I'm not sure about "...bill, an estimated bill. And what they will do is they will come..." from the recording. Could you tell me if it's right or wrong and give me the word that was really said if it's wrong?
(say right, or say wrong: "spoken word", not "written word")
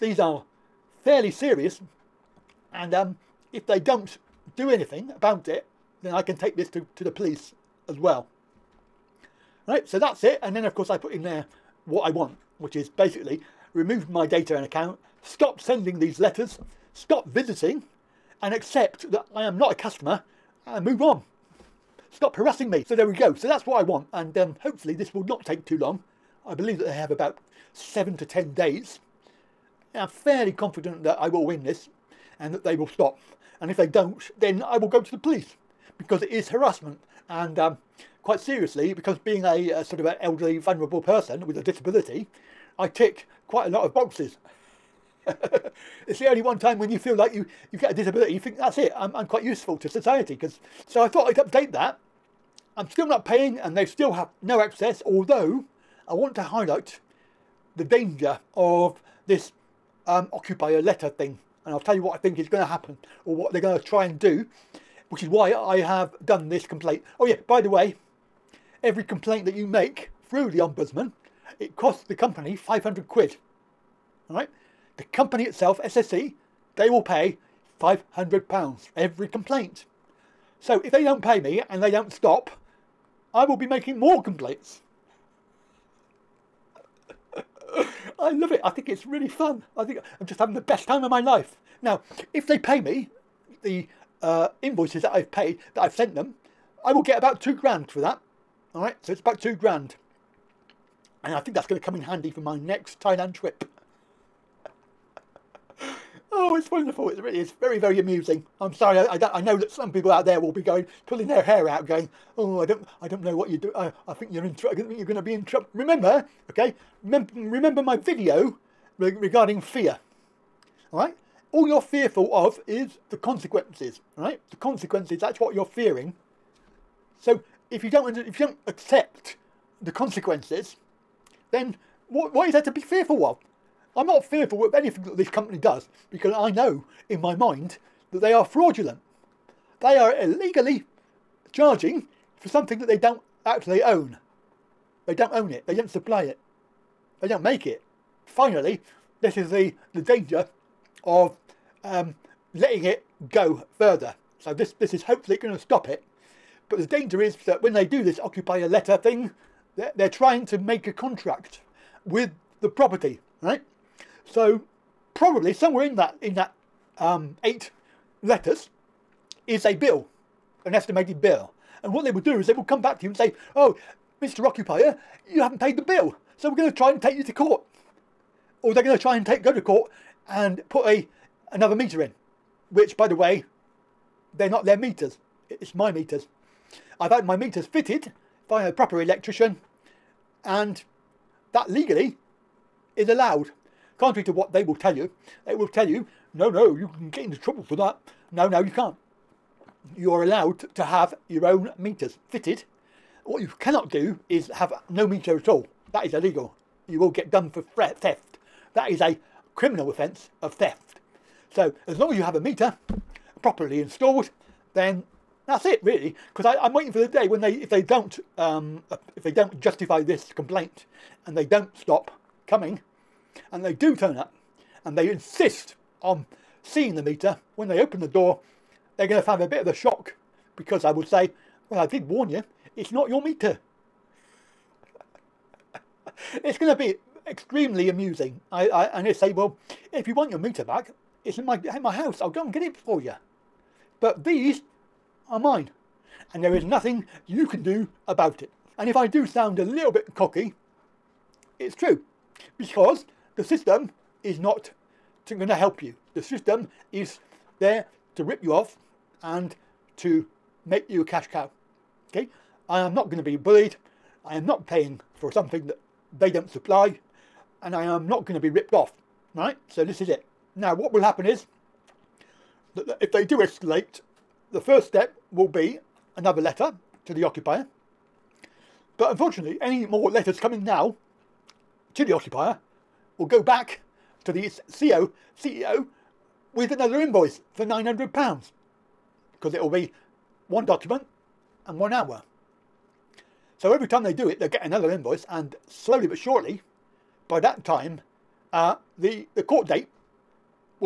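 right.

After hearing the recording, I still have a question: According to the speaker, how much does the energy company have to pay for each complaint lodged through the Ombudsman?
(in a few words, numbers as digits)
£500.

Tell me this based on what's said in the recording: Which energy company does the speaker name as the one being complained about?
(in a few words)
SSE.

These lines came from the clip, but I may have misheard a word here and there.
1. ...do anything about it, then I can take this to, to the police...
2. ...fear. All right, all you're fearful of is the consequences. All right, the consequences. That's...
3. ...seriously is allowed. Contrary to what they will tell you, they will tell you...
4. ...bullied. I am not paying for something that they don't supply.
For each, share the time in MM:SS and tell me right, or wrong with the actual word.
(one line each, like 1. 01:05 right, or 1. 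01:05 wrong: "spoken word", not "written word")
1. 00:04 right
2. 01:59 right
3. 03:11 wrong: "legally", not "seriously"
4. 04:23 right.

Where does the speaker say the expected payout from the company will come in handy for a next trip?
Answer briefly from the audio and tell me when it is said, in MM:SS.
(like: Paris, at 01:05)
Thailand, at 01:42.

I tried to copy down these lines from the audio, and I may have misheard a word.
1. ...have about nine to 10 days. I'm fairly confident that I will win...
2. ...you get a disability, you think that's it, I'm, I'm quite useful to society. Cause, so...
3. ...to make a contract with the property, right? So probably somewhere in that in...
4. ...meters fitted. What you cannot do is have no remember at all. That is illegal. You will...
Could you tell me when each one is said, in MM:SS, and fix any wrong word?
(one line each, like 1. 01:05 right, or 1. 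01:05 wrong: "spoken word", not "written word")
1. 00:26 wrong: "seven", not "nine"
2. 00:47 right
3. 02:40 right
4. 03:21 wrong: "meter", not "remember".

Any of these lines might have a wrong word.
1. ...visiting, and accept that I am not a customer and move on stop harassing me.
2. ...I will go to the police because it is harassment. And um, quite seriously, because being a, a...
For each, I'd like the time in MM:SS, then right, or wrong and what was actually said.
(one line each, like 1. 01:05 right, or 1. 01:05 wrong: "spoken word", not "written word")
1. 00:17 right
2. 00:34 right.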